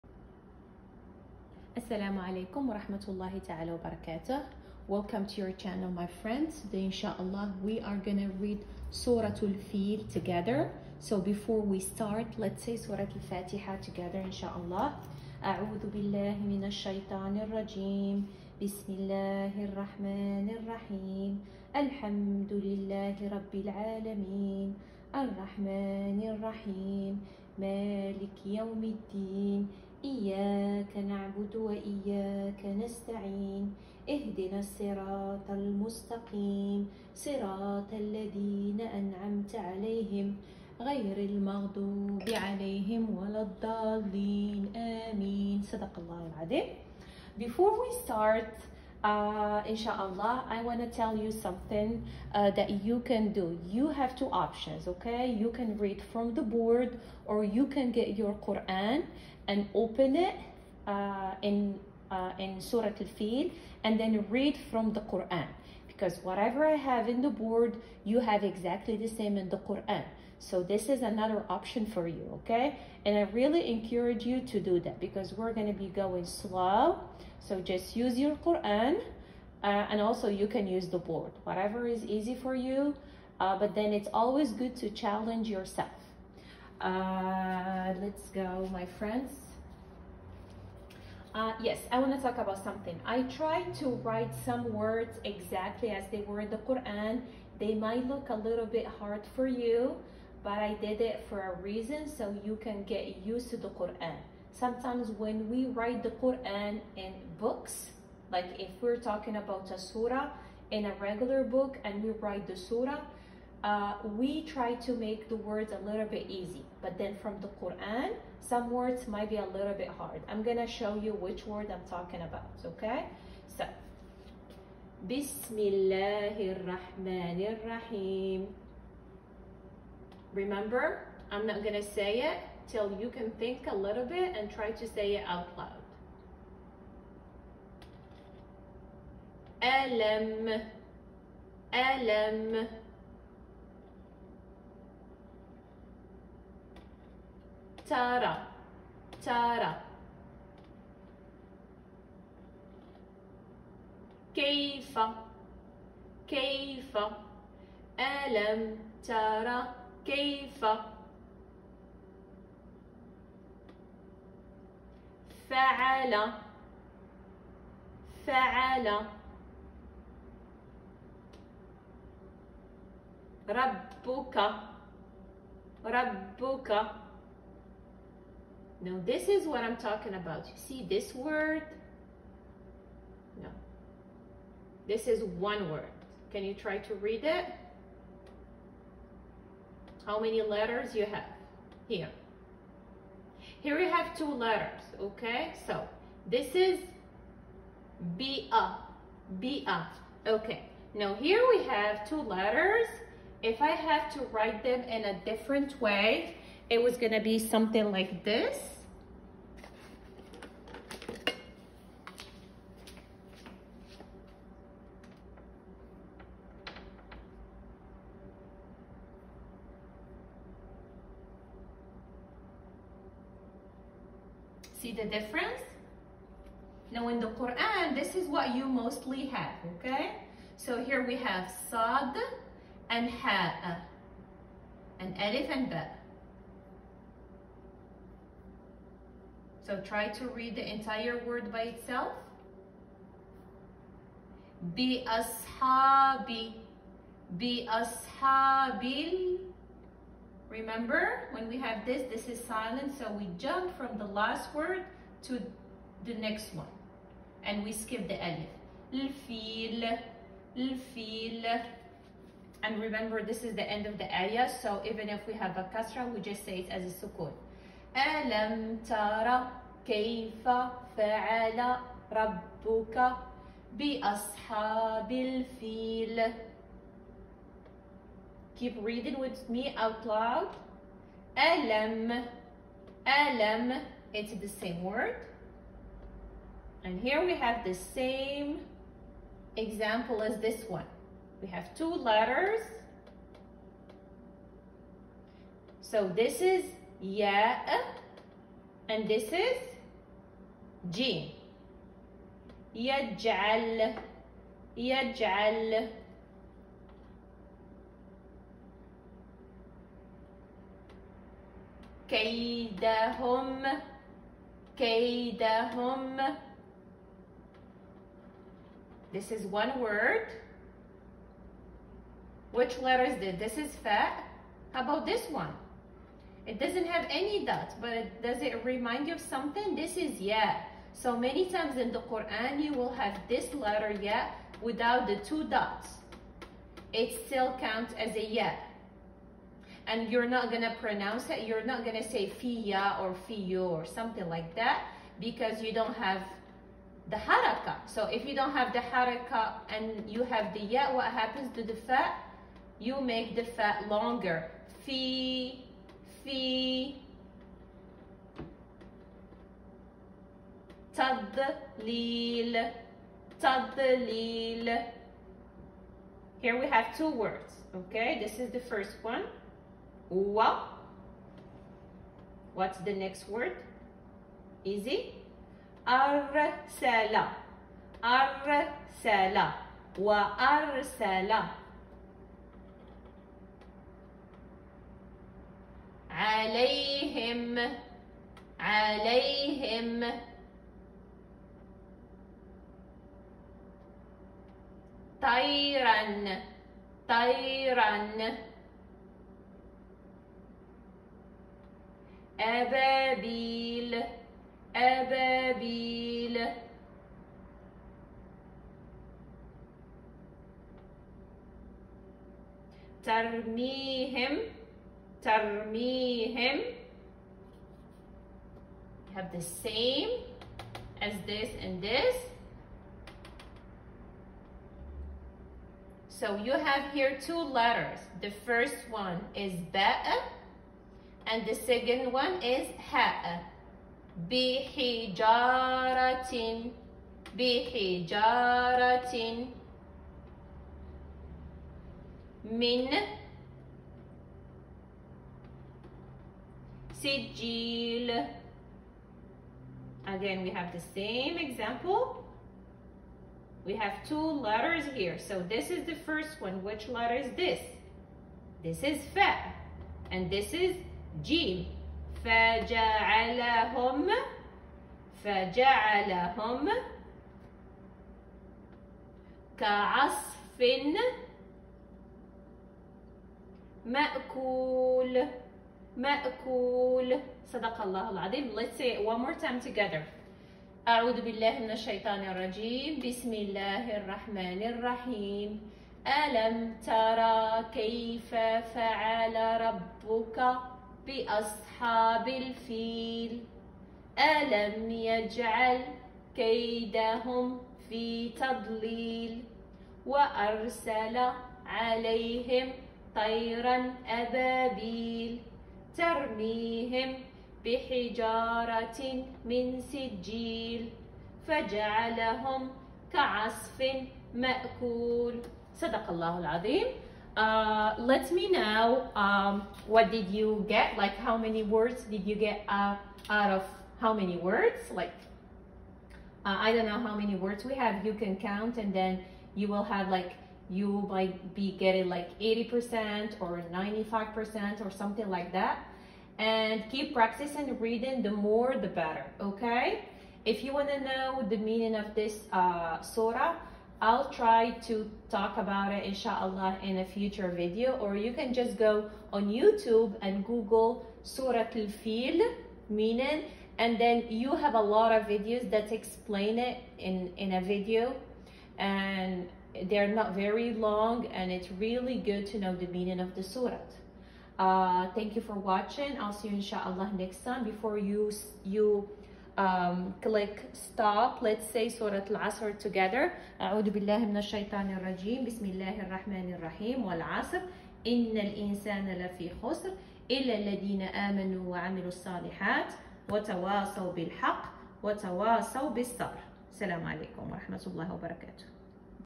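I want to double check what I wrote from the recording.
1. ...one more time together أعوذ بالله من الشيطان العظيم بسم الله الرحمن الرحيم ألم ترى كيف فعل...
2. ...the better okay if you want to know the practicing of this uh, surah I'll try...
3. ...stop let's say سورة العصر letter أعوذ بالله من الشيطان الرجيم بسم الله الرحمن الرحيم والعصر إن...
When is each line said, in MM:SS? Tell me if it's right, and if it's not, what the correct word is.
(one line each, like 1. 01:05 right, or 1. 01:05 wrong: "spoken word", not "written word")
1. 07:59 wrong: "الرجيم", not "العظيم"
2. 08:58 wrong: "meaning", not "practicing"
3. 09:30 wrong: "together", not "letter".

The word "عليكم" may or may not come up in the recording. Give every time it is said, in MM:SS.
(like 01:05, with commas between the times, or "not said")
00:02, 09:47.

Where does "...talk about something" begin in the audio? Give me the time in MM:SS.
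01:32.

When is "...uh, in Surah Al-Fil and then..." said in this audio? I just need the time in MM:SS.
01:02.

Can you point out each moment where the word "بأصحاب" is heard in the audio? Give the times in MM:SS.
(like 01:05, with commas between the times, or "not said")
04:33, 08:11.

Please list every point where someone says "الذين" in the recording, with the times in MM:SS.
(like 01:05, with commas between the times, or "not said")
00:37, 09:40.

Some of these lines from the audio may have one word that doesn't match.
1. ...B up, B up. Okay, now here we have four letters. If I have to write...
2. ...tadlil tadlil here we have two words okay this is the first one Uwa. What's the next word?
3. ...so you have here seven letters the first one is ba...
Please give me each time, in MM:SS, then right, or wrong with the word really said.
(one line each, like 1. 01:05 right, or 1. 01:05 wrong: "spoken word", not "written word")
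1. 03:18 wrong: "two", not "four"
2. 06:00 right
3. 07:06 wrong: "two", not "seven".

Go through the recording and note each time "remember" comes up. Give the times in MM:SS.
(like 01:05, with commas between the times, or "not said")
02:10, 04:10, 04:22.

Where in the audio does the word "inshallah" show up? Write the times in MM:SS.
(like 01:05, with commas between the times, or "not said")
00:06, 00:14, 00:49, 09:06, 09:26.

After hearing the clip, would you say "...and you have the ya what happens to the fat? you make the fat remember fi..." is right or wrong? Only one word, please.
wrong.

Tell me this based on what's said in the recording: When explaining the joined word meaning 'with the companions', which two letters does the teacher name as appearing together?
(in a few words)
sad and ha.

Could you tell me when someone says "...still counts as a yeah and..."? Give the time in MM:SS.
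05:37.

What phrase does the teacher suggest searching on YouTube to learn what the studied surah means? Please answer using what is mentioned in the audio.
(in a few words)
Surah Al-Fil meaning.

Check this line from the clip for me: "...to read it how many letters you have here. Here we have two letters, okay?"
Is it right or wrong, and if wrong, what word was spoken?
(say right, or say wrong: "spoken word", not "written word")
right.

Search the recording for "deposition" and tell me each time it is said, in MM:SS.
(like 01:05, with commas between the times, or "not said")
not said.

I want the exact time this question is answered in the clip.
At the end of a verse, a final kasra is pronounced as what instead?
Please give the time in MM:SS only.
04:27.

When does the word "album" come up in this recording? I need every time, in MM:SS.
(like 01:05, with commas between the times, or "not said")
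not said.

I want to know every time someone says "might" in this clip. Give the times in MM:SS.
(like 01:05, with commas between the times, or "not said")
01:37, 01:59, 08:51.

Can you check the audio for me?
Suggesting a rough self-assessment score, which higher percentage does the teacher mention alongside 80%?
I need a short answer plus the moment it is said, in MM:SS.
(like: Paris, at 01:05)
95%, at 08:53.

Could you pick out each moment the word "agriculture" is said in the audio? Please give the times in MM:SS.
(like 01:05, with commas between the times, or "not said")
not said.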